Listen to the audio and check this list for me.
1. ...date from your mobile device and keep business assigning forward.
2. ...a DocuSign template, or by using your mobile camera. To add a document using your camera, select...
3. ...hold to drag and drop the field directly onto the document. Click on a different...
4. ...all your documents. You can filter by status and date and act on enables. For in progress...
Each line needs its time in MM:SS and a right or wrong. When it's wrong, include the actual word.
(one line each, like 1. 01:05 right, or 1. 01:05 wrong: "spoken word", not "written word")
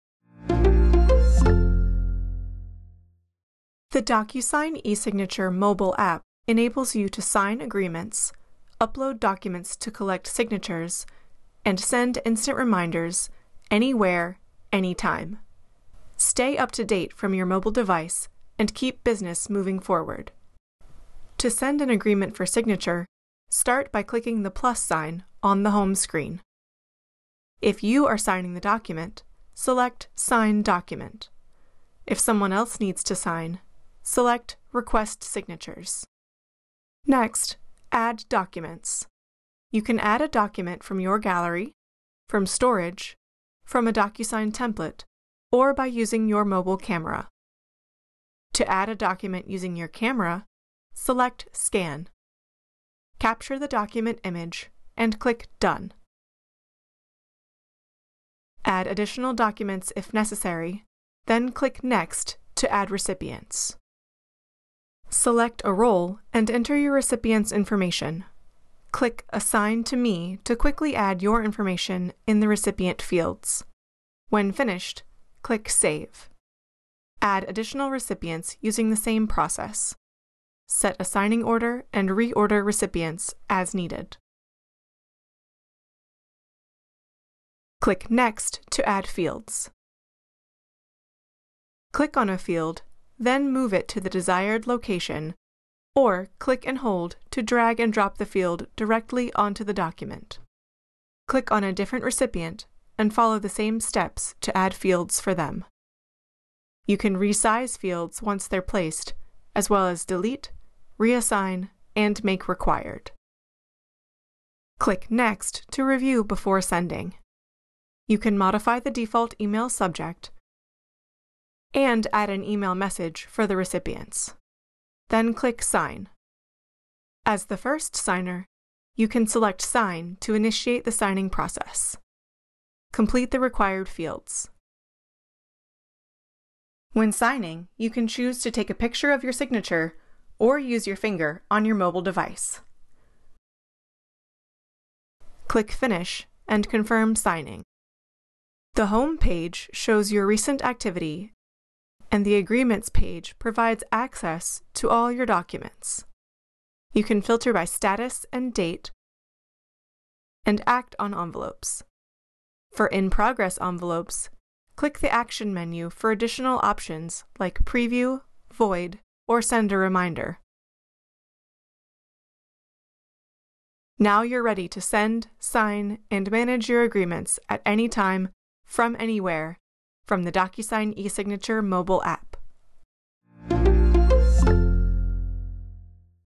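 1. 00:16 wrong: "moving", not "assigning"
2. 00:43 right
3. 01:36 right
4. 02:34 wrong: "envelopes", not "enables".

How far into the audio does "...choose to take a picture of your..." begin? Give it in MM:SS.
02:18.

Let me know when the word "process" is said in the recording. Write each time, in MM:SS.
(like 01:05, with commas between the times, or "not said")
01:19, 02:11.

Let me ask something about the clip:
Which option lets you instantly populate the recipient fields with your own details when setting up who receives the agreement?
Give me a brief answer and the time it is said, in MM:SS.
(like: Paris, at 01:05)
Assign to Me, at 01:09.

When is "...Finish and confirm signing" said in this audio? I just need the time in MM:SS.
02:25.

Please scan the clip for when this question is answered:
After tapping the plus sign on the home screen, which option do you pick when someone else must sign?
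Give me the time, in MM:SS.
00:34.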